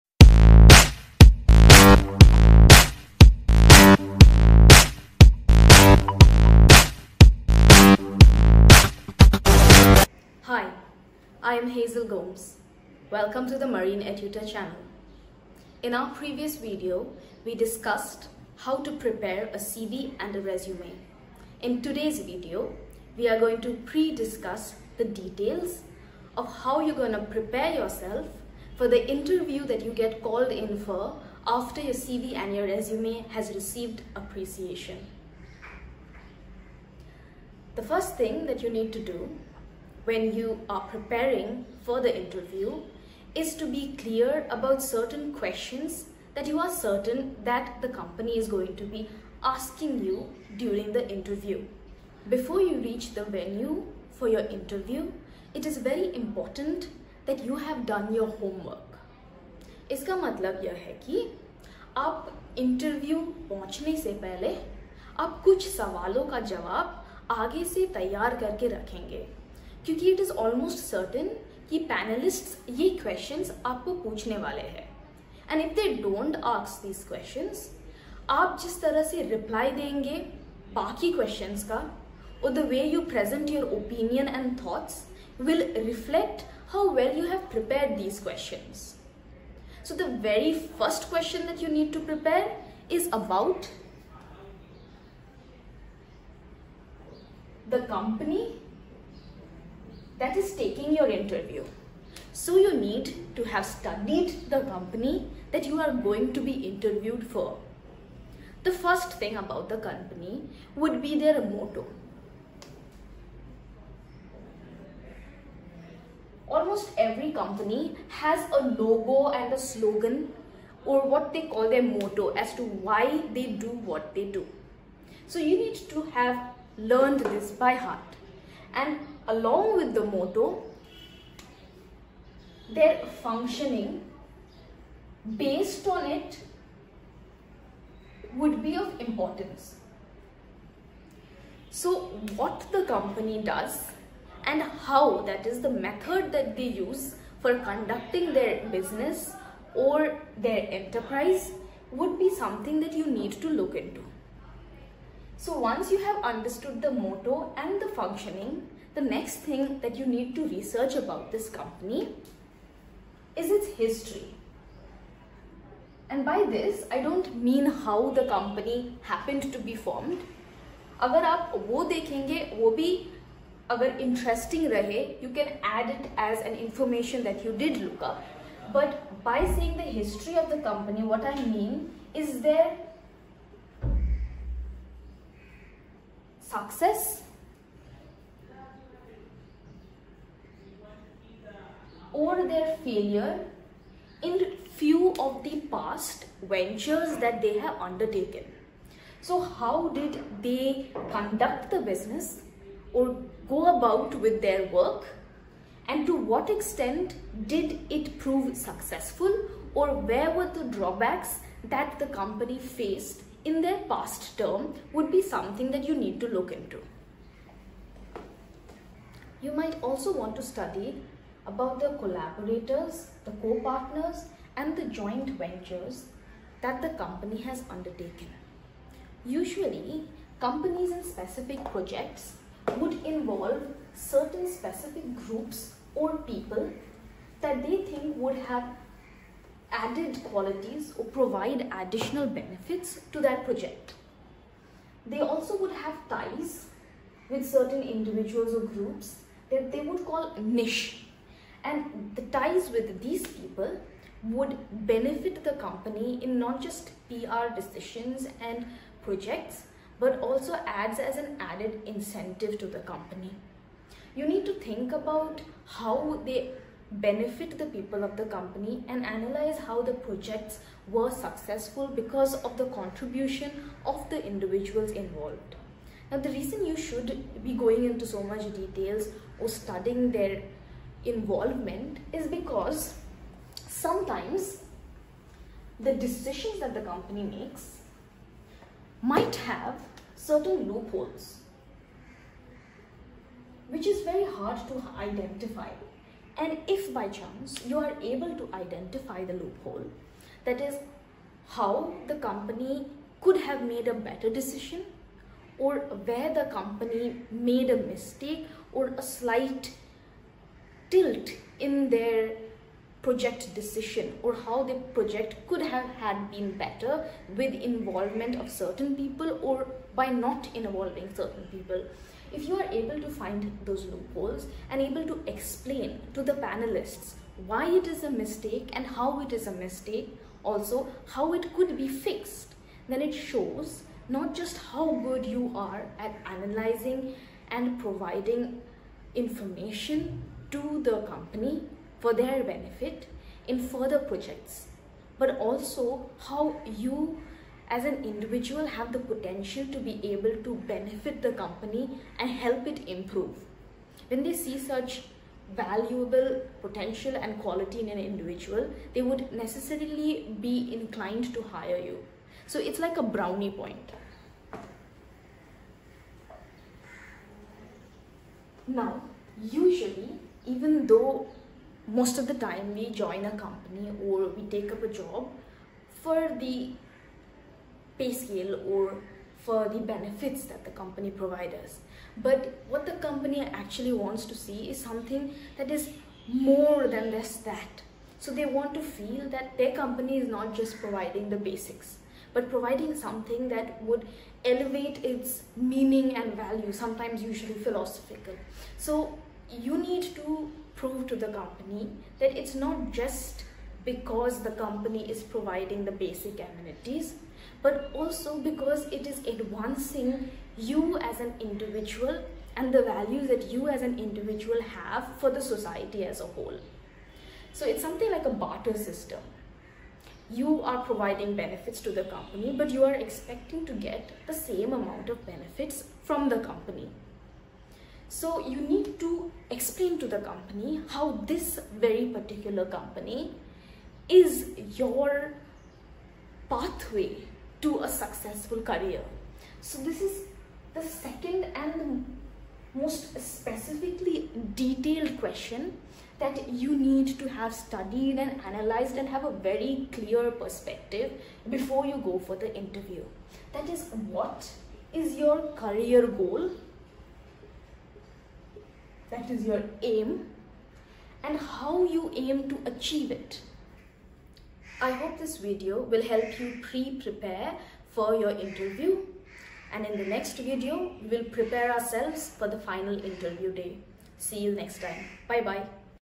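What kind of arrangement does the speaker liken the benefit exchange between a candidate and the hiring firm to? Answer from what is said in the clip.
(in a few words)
A barter system.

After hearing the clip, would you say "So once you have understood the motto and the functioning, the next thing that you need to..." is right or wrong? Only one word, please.
right.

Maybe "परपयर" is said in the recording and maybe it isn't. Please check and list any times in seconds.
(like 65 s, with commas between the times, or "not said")
87 s, 92 s.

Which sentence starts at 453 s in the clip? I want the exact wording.
That is what is your career goal that is your aim and how you aim to achieve it.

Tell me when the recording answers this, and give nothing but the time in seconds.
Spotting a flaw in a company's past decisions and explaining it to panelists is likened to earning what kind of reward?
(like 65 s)
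363 s.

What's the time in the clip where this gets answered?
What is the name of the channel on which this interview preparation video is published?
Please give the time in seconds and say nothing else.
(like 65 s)
13 s.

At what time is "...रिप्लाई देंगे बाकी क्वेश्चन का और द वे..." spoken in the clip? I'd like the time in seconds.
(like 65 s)
79 s.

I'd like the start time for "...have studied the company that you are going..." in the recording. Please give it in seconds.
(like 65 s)
103 s.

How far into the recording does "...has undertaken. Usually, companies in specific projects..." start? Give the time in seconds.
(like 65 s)
227 s.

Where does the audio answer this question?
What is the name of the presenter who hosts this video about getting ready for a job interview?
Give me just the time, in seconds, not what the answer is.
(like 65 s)
11 s.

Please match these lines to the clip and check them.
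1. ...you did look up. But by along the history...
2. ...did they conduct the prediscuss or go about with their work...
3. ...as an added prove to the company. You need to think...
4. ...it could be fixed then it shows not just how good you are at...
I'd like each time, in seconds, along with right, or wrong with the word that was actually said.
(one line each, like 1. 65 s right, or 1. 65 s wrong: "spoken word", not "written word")
1. 177 s wrong: "saying", not "along"
2. 199 s wrong: "business", not "prediscuss"
3. 260 s wrong: "incentive", not "prove"
4. 331 s right.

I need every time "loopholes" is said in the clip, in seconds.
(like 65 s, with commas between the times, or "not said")
290 s, 299 s, 323 s.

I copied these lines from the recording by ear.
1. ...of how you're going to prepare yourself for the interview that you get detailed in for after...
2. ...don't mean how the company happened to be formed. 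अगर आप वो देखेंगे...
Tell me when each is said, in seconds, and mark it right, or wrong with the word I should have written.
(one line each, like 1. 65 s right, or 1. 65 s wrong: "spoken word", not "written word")
1. 26 s wrong: "called", not "detailed"
2. 167 s right.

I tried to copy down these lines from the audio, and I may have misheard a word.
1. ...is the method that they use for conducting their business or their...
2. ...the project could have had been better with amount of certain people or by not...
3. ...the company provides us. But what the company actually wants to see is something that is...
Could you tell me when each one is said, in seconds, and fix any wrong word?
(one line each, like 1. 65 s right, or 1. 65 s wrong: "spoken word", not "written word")
1. 145 s right
2. 314 s wrong: "involvement", not "amount"
3. 380 s right.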